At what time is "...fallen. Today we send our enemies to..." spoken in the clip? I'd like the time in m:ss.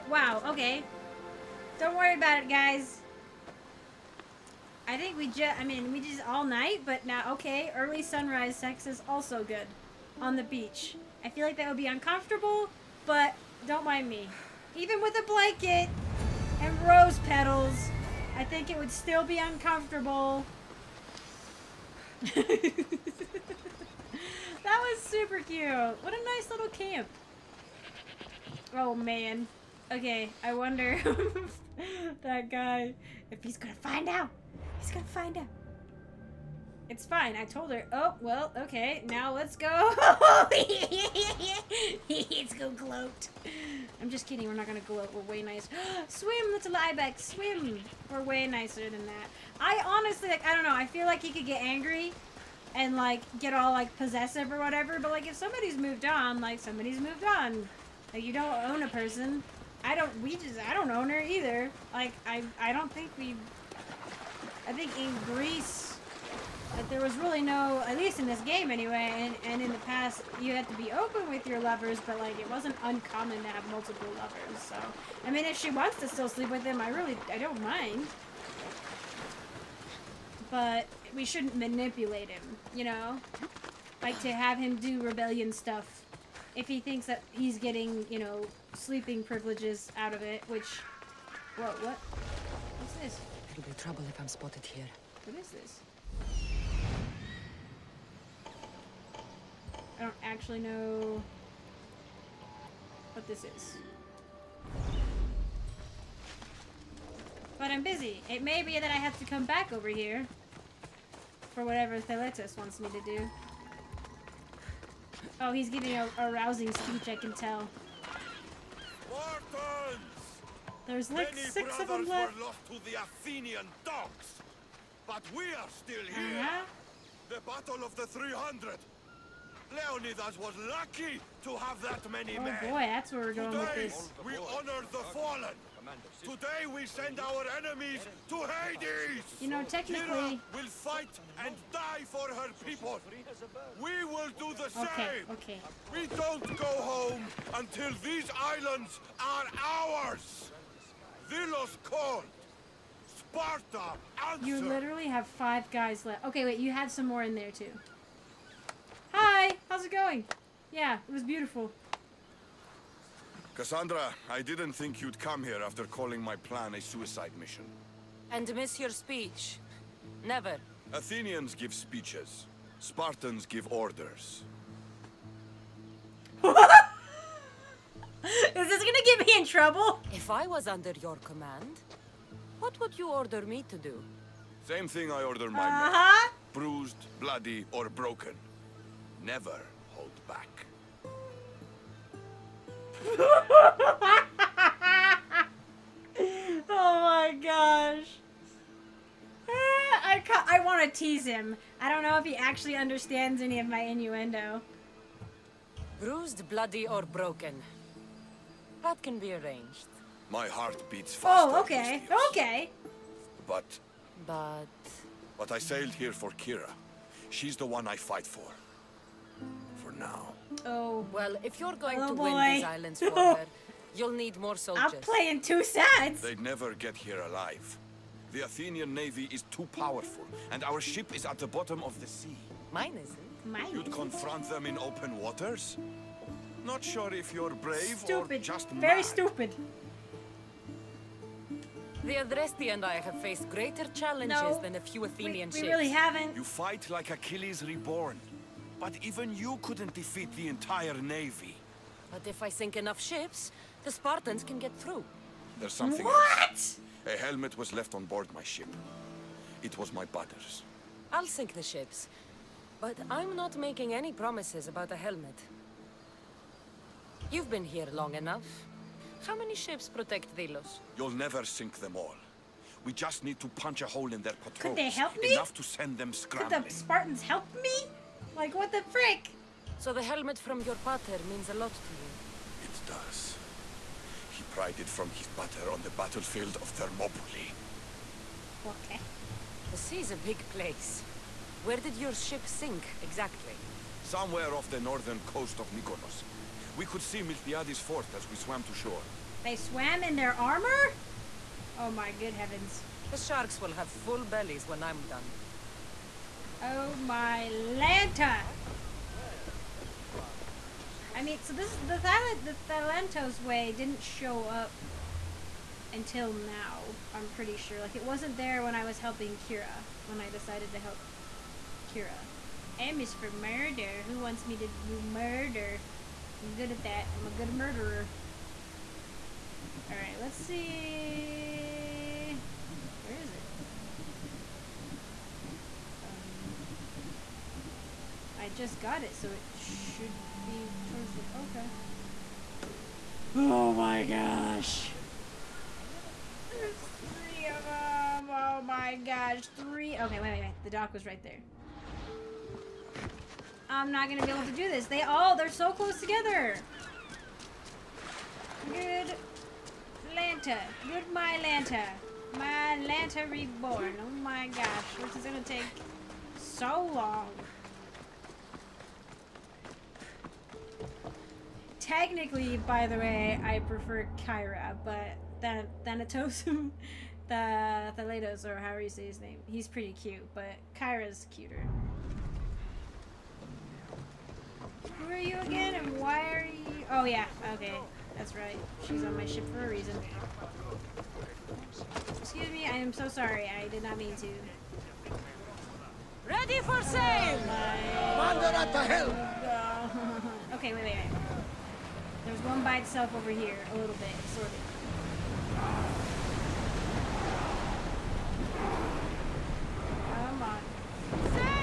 2:15.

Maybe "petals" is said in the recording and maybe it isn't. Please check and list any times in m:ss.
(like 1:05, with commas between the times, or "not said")
0:17.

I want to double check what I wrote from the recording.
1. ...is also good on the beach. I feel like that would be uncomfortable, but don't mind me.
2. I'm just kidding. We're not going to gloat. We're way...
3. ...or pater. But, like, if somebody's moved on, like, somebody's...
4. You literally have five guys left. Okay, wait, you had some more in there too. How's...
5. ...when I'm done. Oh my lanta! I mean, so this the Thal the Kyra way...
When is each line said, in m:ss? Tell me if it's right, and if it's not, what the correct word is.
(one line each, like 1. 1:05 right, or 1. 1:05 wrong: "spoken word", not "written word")
1. 0:08 right
2. 0:44 right
3. 0:54 wrong: "whatever", not "pater"
4. 2:34 right
5. 5:04 wrong: "Thalantos", not "Kyra".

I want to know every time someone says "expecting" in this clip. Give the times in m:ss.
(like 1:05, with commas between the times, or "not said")
not said.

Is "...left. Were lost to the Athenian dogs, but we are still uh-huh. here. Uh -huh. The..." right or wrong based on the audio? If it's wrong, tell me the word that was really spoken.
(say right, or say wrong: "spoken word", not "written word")
right.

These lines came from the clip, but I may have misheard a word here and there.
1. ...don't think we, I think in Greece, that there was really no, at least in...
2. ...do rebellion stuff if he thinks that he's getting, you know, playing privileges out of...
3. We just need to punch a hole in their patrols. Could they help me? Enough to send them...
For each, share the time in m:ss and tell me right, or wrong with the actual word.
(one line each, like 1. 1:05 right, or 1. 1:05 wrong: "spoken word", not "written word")
1. 1:02 right
2. 1:24 wrong: "sleeping", not "playing"
3. 4:32 right.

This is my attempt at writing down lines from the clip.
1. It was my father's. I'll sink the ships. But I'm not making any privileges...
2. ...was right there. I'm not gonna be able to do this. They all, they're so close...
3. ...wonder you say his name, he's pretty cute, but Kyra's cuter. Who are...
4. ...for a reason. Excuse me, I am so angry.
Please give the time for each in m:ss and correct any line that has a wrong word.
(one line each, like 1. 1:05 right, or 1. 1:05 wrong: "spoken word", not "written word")
1. 4:19 wrong: "promises", not "privileges"
2. 5:50 right
3. 6:18 wrong: "however", not "wonder"
4. 6:29 wrong: "sorry", not "angry".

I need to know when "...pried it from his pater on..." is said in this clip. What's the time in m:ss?
4:44.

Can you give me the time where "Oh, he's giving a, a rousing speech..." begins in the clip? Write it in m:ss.
1:55.